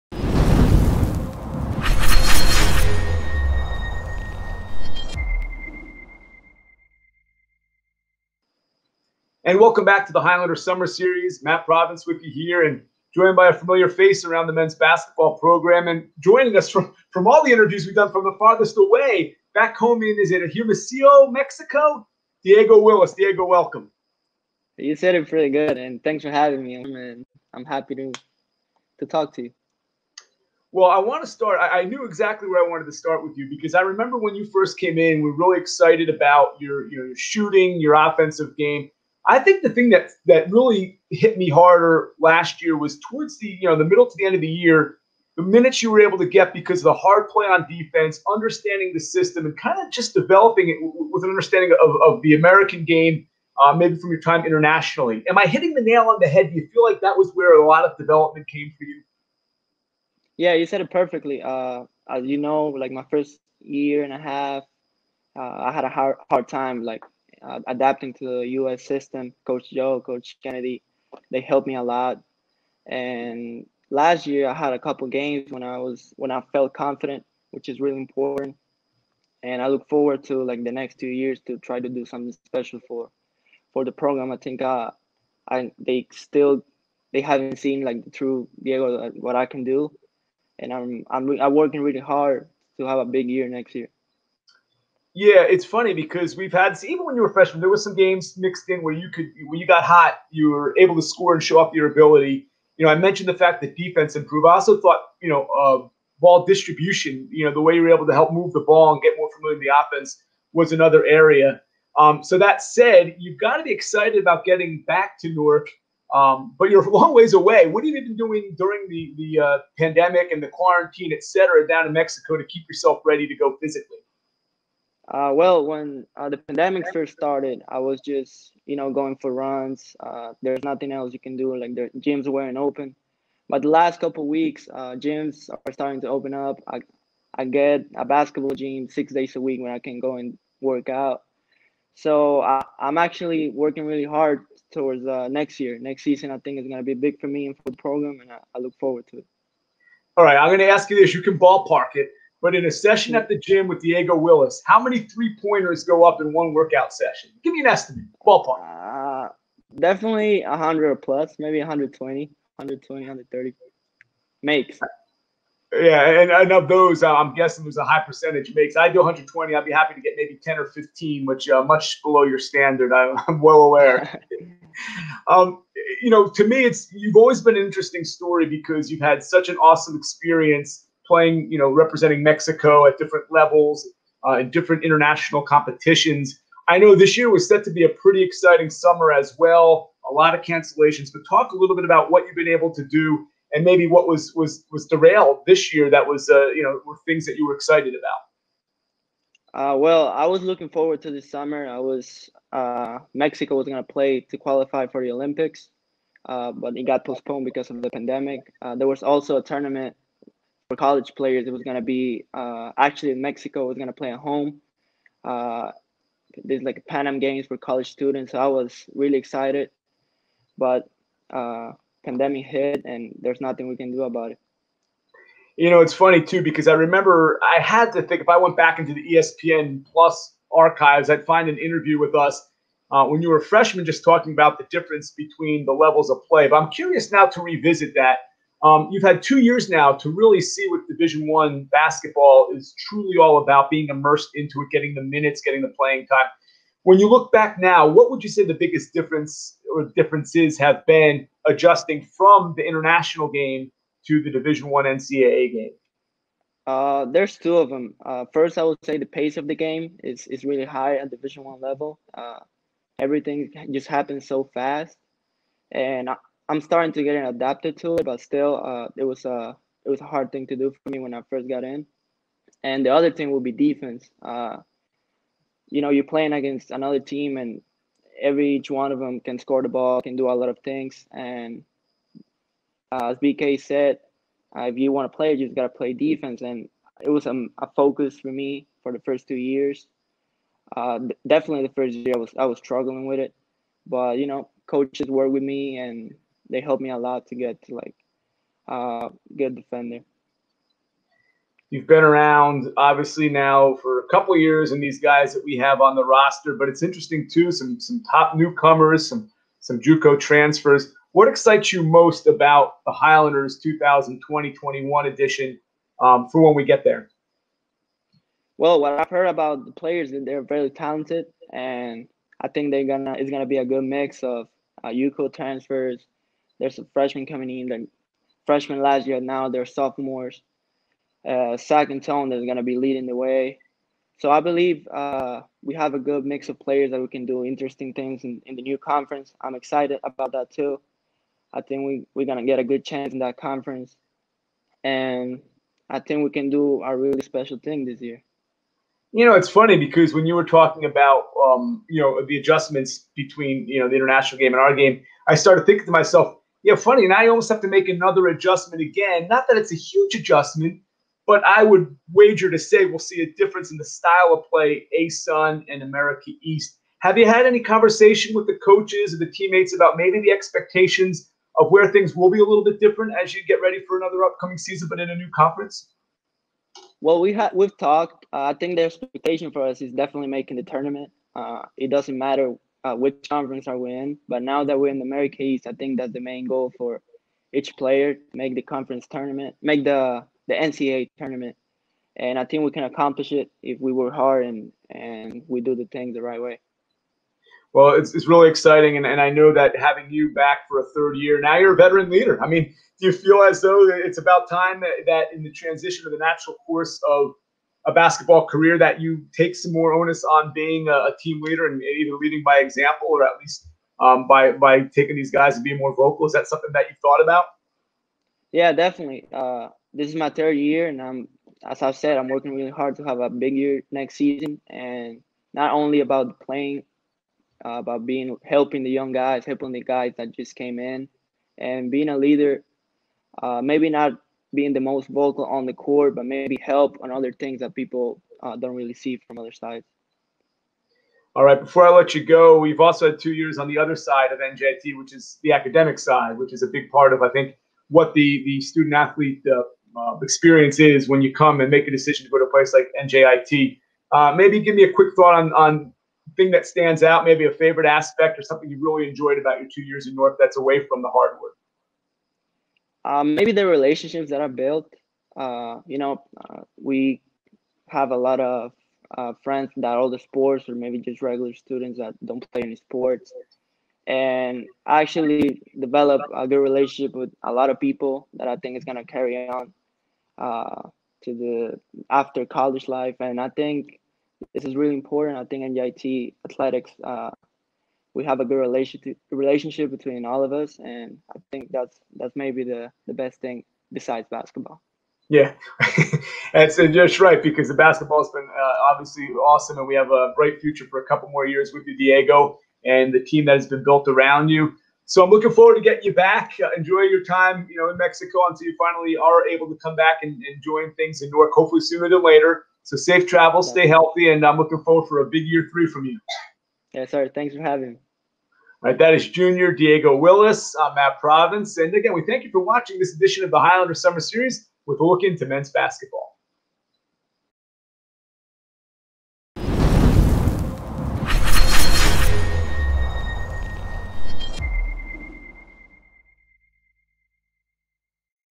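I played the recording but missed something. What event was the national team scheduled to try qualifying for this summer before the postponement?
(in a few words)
The Olympics.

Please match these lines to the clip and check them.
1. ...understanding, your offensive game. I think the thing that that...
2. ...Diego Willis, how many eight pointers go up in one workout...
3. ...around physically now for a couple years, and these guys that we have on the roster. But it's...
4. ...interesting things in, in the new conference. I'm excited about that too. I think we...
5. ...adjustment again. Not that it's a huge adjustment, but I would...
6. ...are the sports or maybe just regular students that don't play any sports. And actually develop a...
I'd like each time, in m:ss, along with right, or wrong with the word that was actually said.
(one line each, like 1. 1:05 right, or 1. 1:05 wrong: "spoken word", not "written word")
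1. 0:37 wrong: "shooting", not "understanding"
2. 2:33 wrong: "three", not "eight"
3. 5:02 wrong: "obviously", not "physically"
4. 5:37 right
5. 5:58 right
6. 7:49 right.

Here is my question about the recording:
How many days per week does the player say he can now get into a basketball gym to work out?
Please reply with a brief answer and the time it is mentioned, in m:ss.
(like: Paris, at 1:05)
6, at 2:18.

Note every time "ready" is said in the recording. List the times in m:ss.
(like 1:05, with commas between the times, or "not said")
2:03, 6:13.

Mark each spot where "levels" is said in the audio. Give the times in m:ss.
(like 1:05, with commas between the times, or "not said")
3:03, 3:55, 4:21.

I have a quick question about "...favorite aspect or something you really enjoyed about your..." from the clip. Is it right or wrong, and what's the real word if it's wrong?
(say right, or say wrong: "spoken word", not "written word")
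right.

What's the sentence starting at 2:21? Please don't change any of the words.
So I, am actually working really hard towards uh, next year.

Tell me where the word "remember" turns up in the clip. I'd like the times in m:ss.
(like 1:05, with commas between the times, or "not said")
0:33, 3:46.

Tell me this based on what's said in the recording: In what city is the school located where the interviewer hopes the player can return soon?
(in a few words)
Newark.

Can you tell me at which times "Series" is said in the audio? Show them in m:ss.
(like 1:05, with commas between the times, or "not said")
0:10, 8:44.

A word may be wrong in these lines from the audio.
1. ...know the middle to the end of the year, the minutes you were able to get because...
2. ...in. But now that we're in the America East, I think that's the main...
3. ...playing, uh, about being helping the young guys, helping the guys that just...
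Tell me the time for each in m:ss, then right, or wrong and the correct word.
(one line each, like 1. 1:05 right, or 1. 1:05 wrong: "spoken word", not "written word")
1. 0:43 right
2. 6:23 right
3. 7:06 right.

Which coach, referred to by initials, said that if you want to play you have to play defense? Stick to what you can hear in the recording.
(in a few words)
BK.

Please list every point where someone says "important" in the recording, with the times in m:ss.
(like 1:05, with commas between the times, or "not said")
1:17, 8:04.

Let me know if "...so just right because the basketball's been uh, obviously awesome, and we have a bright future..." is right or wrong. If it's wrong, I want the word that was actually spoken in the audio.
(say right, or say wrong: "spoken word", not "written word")
right.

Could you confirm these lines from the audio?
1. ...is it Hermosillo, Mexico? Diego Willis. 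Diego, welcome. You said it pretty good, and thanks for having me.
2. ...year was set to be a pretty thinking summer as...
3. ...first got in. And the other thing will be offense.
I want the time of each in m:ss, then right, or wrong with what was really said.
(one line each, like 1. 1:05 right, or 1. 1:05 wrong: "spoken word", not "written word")
1. 0:20 right
2. 3:07 wrong: "exciting", not "thinking"
3. 4:31 wrong: "defense", not "offense".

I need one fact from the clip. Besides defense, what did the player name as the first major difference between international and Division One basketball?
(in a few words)
The pace of the game.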